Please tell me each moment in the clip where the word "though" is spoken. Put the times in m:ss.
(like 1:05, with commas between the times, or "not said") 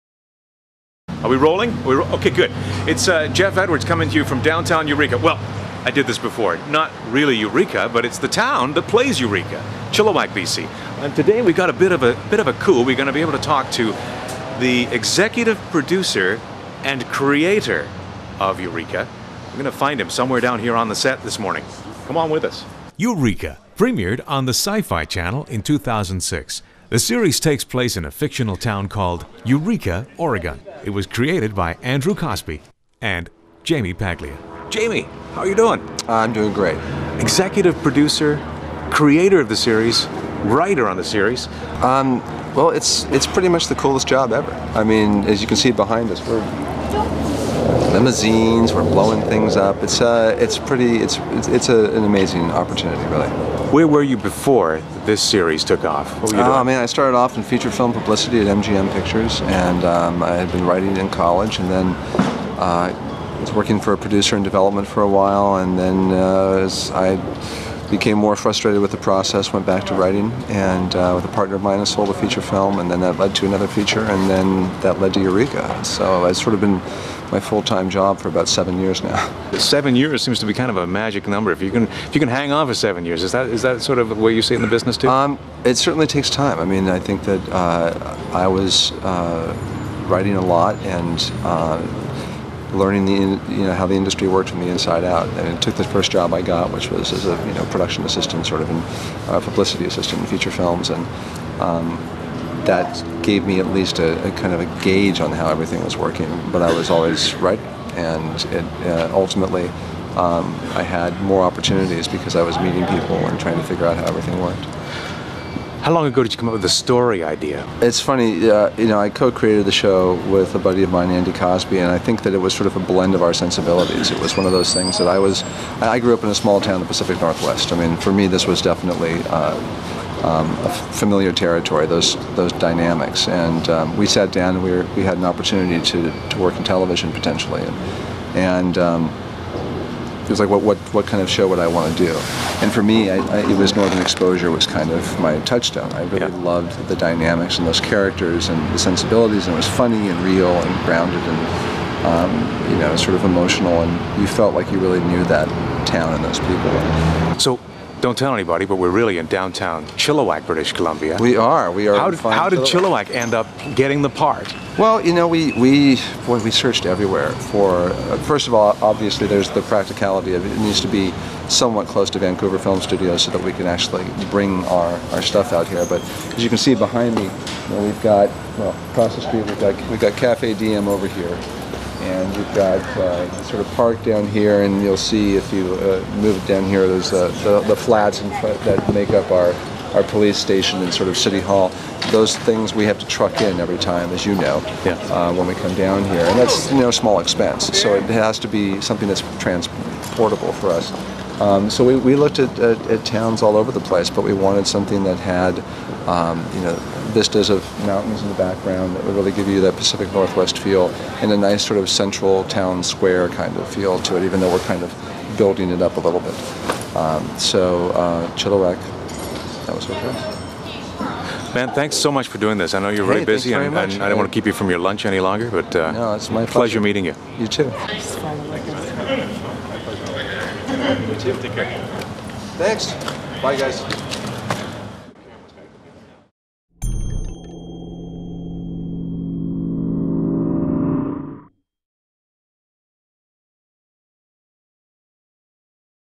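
3:34.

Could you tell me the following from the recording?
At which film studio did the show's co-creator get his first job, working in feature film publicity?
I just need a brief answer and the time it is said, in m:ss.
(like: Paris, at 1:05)
MGM Pictures, at 0:58.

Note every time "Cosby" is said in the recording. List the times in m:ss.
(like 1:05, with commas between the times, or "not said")
0:32, 2:01.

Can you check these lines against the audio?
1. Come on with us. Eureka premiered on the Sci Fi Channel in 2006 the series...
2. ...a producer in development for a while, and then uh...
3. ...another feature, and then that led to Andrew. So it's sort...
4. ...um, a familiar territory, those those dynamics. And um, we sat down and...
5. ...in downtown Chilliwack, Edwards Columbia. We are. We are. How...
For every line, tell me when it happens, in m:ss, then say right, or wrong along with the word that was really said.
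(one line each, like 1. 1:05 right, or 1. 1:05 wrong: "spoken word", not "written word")
1. 0:22 right
2. 1:03 right
3. 1:13 wrong: "Eureka", not "Andrew"
4. 2:10 right
5. 2:39 wrong: "British", not "Edwards".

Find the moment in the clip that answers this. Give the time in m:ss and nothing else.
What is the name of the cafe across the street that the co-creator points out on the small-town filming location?
3:00.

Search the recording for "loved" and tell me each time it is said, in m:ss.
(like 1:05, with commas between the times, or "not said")
2:26.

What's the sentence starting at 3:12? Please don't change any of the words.
Those things we have to truck in every time, as you know, yeah.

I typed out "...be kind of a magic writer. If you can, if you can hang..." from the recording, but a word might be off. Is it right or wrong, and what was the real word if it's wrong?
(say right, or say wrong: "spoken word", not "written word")
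wrong: "number", not "writer".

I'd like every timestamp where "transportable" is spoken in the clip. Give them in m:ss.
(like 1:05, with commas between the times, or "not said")
3:19.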